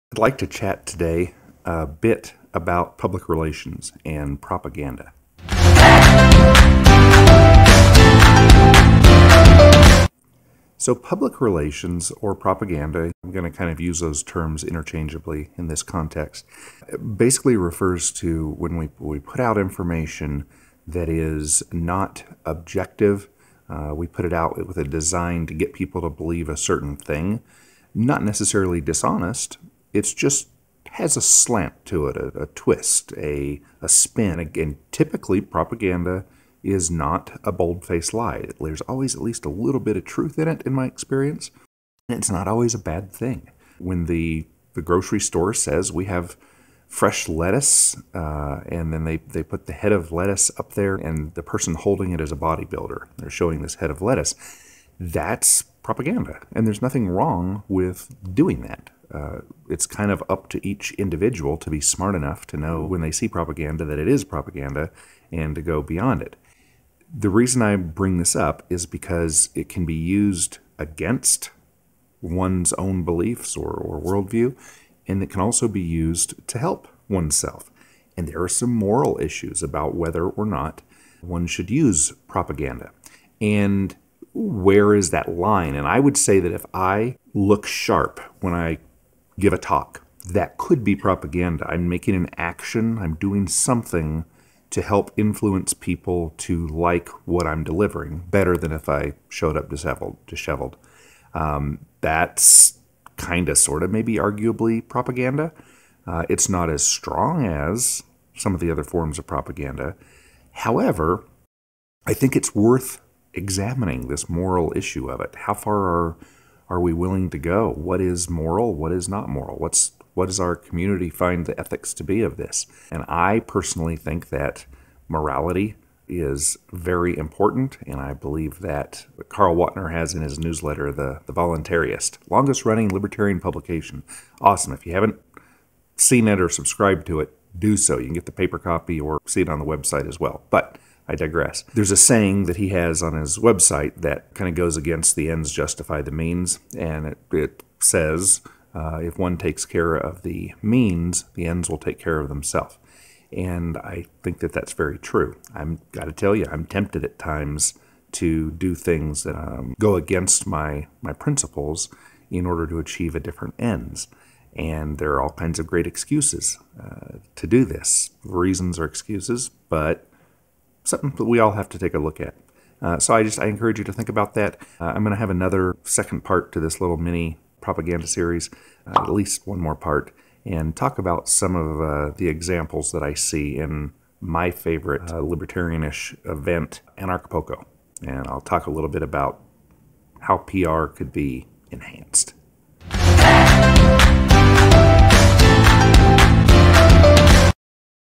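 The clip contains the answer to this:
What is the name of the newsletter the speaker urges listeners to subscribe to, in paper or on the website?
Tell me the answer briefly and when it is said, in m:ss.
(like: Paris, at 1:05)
The Voluntaryist, at 2:11.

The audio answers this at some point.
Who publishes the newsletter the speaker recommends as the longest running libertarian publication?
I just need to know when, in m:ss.
2:09.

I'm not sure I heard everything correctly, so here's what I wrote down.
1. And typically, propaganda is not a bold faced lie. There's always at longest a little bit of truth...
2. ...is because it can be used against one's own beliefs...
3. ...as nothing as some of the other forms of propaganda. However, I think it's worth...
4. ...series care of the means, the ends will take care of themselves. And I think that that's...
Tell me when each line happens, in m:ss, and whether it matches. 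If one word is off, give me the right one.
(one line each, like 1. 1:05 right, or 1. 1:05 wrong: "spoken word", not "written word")
1. 0:34 wrong: "least", not "longest"
2. 1:08 right
3. 1:46 wrong: "strong", not "nothing"
4. 2:29 wrong: "takes", not "series".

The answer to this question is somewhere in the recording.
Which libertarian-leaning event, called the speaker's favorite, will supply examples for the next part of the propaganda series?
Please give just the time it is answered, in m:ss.
3:06.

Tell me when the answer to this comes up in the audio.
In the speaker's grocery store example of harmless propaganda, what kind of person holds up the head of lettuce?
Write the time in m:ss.
0:52.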